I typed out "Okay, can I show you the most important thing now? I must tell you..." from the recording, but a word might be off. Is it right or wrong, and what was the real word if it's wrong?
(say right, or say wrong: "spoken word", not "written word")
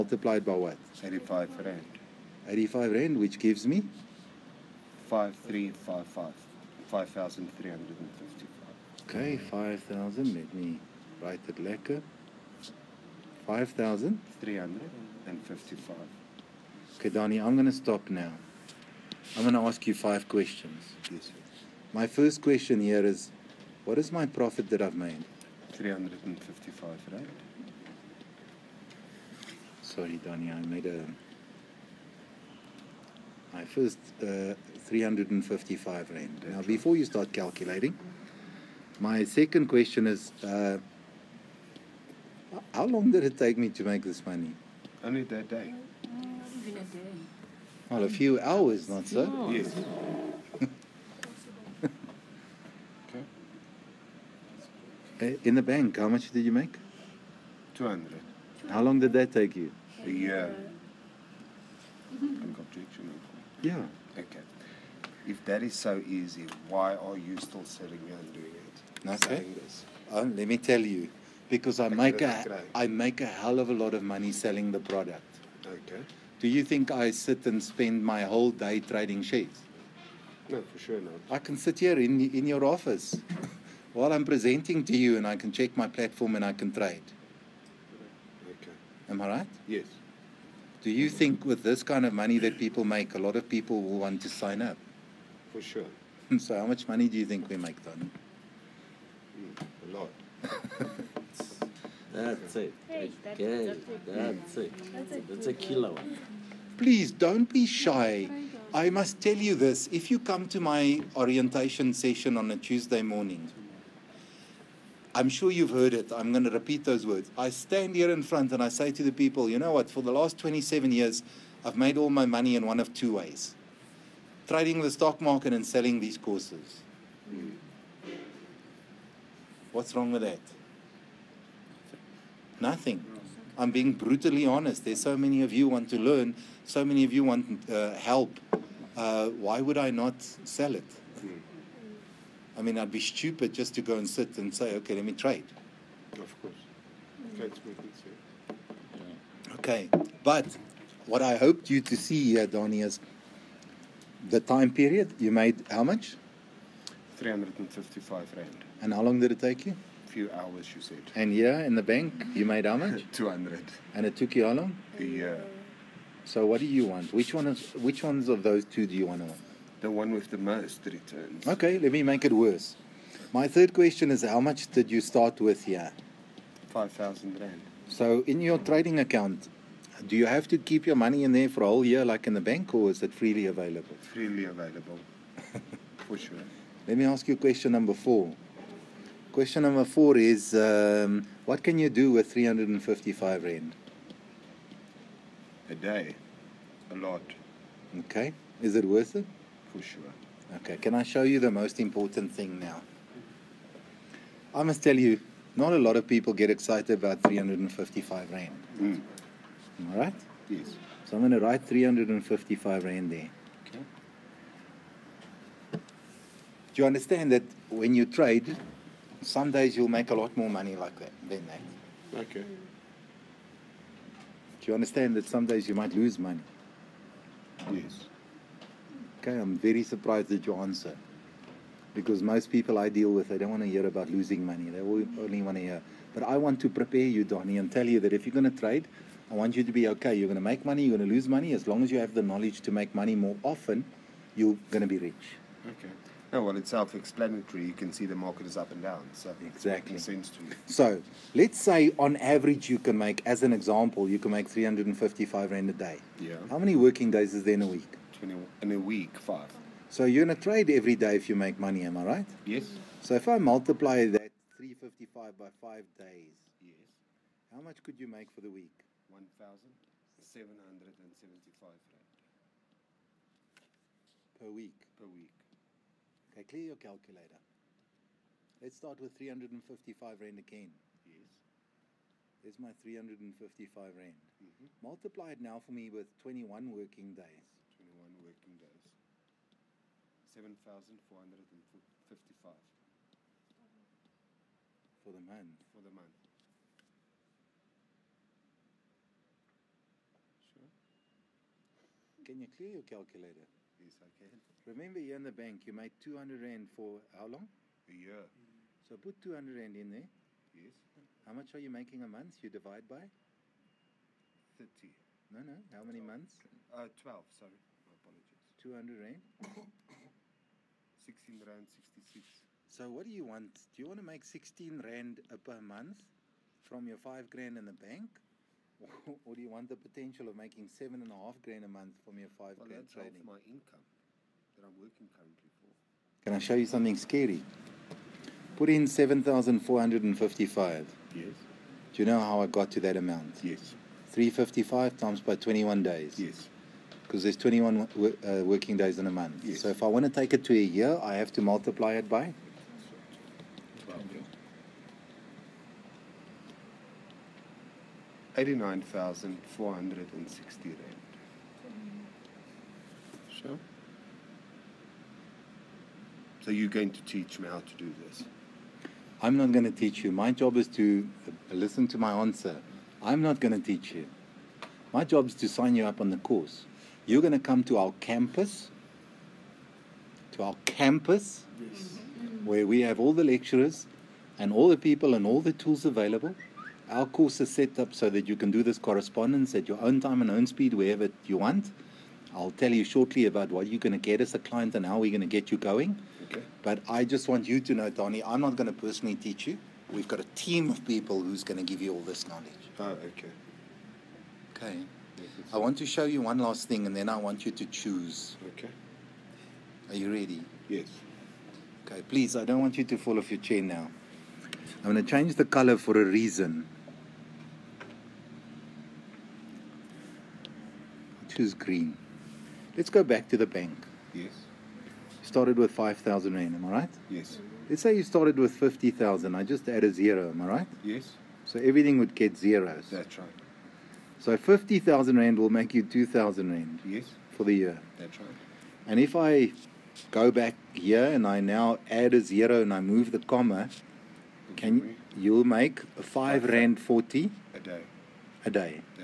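right.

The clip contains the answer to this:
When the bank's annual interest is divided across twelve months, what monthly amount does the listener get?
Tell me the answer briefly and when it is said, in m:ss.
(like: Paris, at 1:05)
R16.66, at 5:20.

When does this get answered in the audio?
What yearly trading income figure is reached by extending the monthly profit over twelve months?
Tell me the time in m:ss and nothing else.
5:58.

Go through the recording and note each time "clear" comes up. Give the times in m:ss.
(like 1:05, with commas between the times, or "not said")
4:36, 5:02.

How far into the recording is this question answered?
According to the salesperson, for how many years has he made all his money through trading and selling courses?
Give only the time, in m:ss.
2:00.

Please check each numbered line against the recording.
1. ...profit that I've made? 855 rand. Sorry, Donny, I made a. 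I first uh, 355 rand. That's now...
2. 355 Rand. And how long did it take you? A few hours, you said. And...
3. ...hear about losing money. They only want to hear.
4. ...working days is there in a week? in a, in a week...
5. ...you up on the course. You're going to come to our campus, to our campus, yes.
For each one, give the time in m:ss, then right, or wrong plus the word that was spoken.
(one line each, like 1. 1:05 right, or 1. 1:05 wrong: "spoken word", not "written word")
1. 0:24 wrong: "355", not "855"
2. 2:37 right
3. 3:53 right
4. 4:16 right
5. 6:15 right.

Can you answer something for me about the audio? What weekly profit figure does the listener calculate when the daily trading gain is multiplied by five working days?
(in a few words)
R1,775.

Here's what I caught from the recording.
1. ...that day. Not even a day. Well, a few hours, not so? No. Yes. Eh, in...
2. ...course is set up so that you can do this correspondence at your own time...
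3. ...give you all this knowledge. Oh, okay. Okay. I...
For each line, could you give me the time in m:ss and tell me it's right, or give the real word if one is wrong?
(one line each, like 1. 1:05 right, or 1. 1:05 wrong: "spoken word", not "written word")
1. 0:45 right
2. 6:27 right
3. 6:41 right.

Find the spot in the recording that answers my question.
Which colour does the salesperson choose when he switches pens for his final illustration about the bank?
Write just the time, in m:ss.
7:01.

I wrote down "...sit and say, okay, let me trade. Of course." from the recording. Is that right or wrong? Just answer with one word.
right.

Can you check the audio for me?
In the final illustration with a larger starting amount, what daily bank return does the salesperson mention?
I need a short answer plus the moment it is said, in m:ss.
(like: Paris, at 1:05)
R5.40, at 7:25.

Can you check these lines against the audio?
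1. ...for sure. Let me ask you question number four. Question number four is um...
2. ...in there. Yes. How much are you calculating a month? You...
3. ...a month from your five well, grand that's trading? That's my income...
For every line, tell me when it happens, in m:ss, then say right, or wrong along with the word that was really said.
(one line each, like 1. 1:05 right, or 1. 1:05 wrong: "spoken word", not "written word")
1. 3:06 right
2. 5:09 wrong: "making", not "calculating"
3. 5:31 right.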